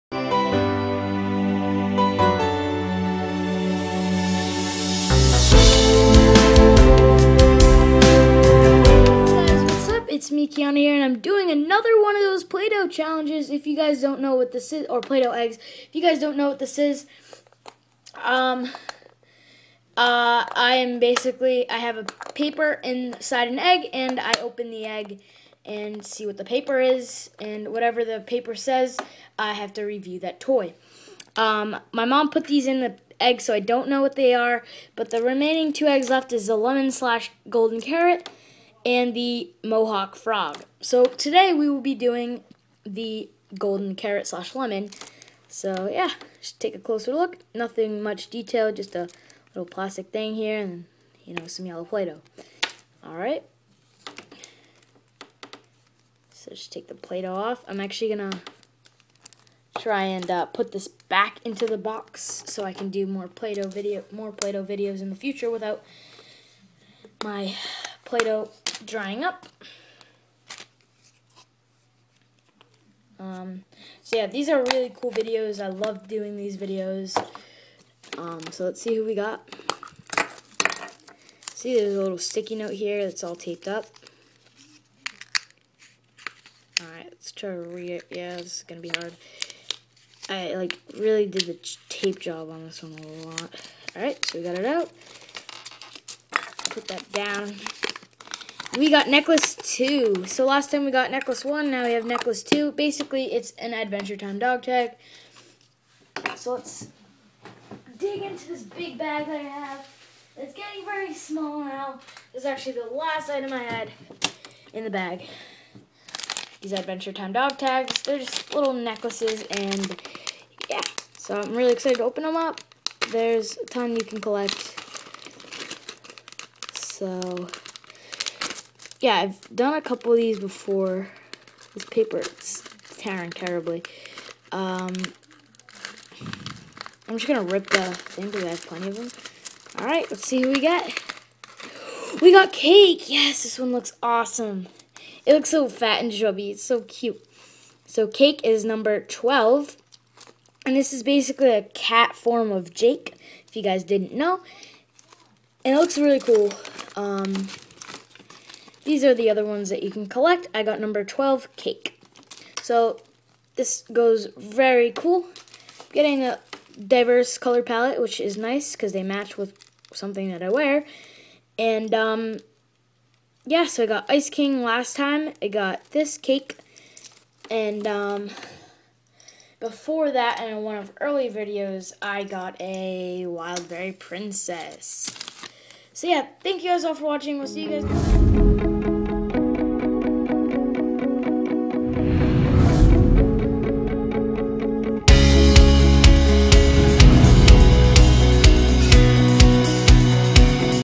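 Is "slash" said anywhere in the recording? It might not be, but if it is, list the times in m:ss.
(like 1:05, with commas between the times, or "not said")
0:36, 0:44.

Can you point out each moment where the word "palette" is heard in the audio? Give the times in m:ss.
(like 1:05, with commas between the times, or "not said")
2:47.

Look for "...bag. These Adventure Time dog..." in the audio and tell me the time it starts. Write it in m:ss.
1:54.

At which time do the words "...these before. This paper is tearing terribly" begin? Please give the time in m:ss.
2:10.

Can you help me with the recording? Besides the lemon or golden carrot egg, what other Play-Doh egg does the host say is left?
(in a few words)
Mohawk Frog.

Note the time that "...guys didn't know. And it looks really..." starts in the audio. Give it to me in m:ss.
2:33.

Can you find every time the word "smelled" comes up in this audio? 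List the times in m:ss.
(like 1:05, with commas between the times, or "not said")
not said.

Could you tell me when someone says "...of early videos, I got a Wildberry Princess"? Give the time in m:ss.
3:00.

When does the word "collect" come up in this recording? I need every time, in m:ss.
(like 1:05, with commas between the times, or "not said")
2:04, 2:40.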